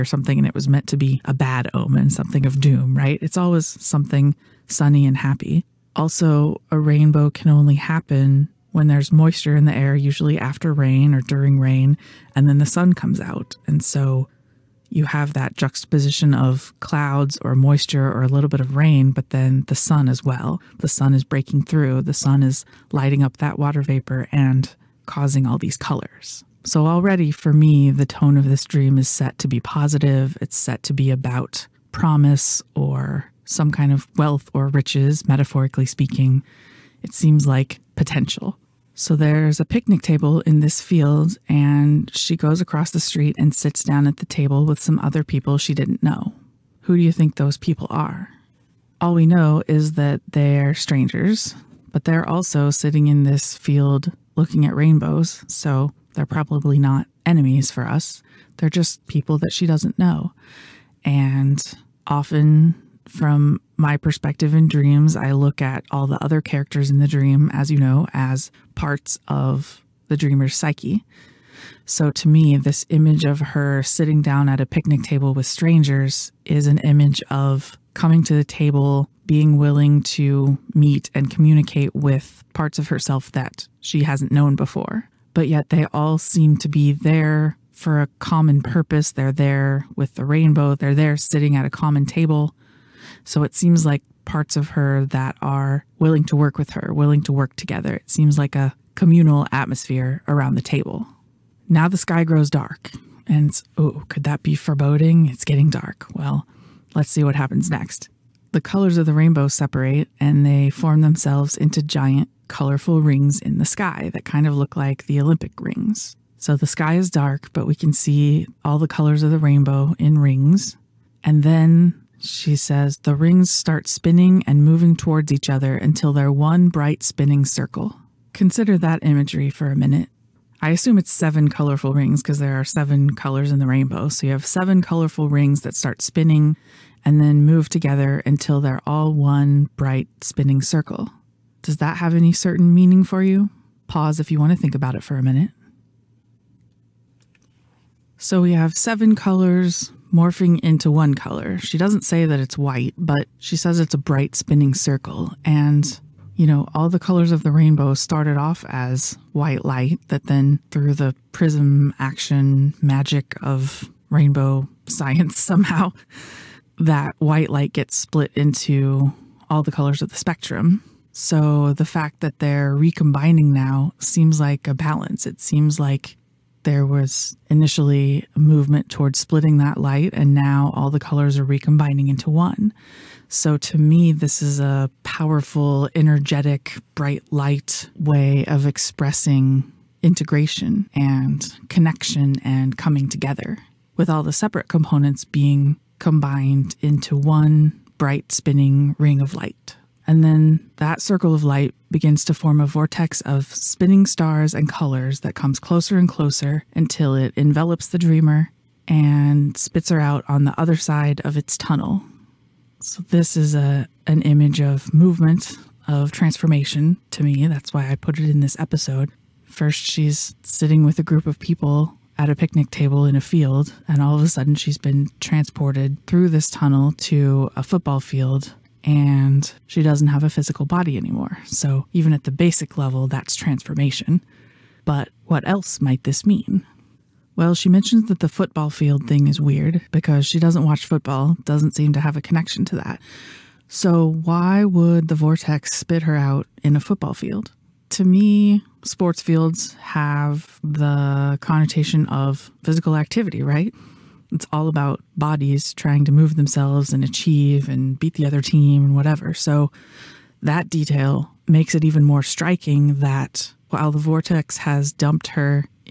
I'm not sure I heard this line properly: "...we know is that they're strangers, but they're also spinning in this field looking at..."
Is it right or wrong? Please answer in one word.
wrong.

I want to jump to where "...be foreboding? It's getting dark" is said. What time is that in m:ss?
1:44.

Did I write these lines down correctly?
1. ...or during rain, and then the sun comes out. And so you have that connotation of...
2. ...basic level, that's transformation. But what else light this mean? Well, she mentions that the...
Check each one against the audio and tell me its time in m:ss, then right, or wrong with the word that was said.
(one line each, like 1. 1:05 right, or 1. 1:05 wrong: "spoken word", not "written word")
1. 0:11 wrong: "juxtaposition", not "connotation"
2. 3:52 wrong: "might", not "light".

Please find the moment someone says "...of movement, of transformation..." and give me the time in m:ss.
3:34.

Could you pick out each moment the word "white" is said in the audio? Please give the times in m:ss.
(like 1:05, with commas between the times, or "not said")
2:32, 2:39, 2:47.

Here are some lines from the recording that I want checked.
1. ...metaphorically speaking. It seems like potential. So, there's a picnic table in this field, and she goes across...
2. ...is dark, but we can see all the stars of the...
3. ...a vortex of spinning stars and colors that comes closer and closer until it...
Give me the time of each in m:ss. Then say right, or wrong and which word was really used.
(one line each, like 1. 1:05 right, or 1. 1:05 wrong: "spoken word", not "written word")
1. 0:35 right
2. 1:56 wrong: "colors", not "stars"
3. 3:22 right.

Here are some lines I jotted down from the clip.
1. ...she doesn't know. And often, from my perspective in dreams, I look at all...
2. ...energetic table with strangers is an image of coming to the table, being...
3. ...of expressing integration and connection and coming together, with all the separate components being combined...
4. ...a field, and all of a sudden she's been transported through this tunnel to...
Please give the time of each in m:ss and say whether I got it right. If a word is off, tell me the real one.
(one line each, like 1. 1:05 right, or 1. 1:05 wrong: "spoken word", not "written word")
1. 0:59 right
2. 1:14 wrong: "picnic", not "energetic"
3. 3:08 right
4. 3:43 right.